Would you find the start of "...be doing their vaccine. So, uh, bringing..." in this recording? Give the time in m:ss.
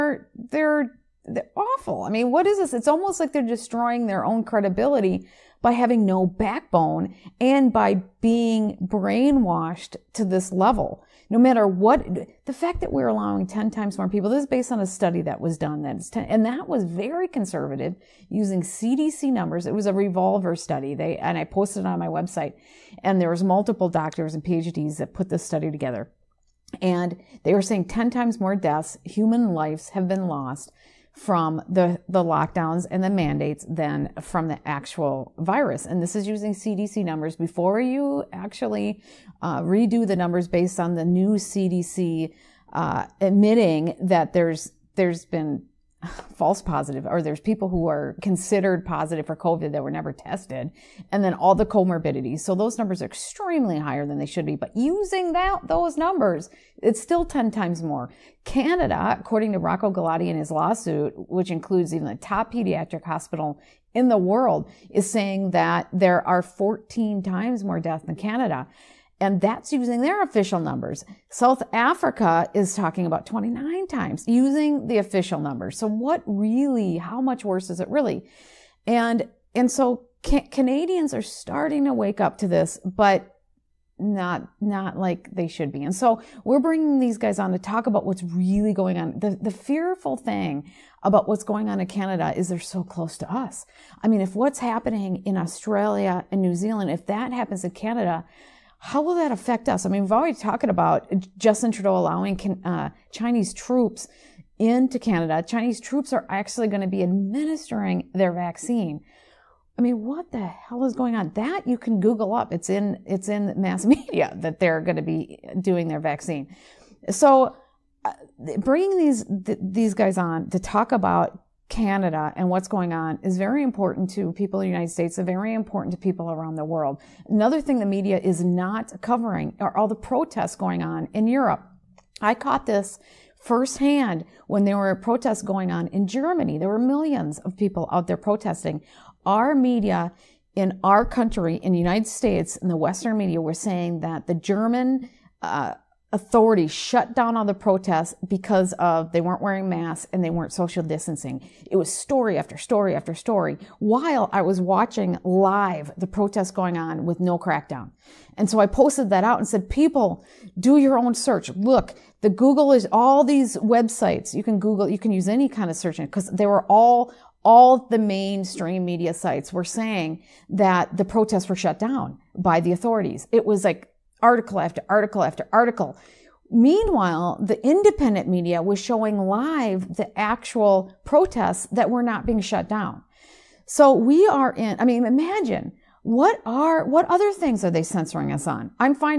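1:55.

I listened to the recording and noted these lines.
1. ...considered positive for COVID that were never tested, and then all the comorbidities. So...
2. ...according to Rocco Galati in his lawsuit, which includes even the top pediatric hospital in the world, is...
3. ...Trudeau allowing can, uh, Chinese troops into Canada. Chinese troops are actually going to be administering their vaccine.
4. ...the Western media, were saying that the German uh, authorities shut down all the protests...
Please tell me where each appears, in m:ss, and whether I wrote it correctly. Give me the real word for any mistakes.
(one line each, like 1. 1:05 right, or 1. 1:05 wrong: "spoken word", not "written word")
1. 0:48 right
2. 0:59 right
3. 1:41 right
4. 2:22 right.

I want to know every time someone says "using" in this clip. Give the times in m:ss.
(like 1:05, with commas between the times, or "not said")
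0:18, 0:36, 0:54, 1:09, 1:14.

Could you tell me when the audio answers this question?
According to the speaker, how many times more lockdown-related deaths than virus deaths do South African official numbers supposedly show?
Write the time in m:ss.
1:13.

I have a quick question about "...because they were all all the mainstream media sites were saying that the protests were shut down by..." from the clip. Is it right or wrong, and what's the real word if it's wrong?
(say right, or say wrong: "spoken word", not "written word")
right.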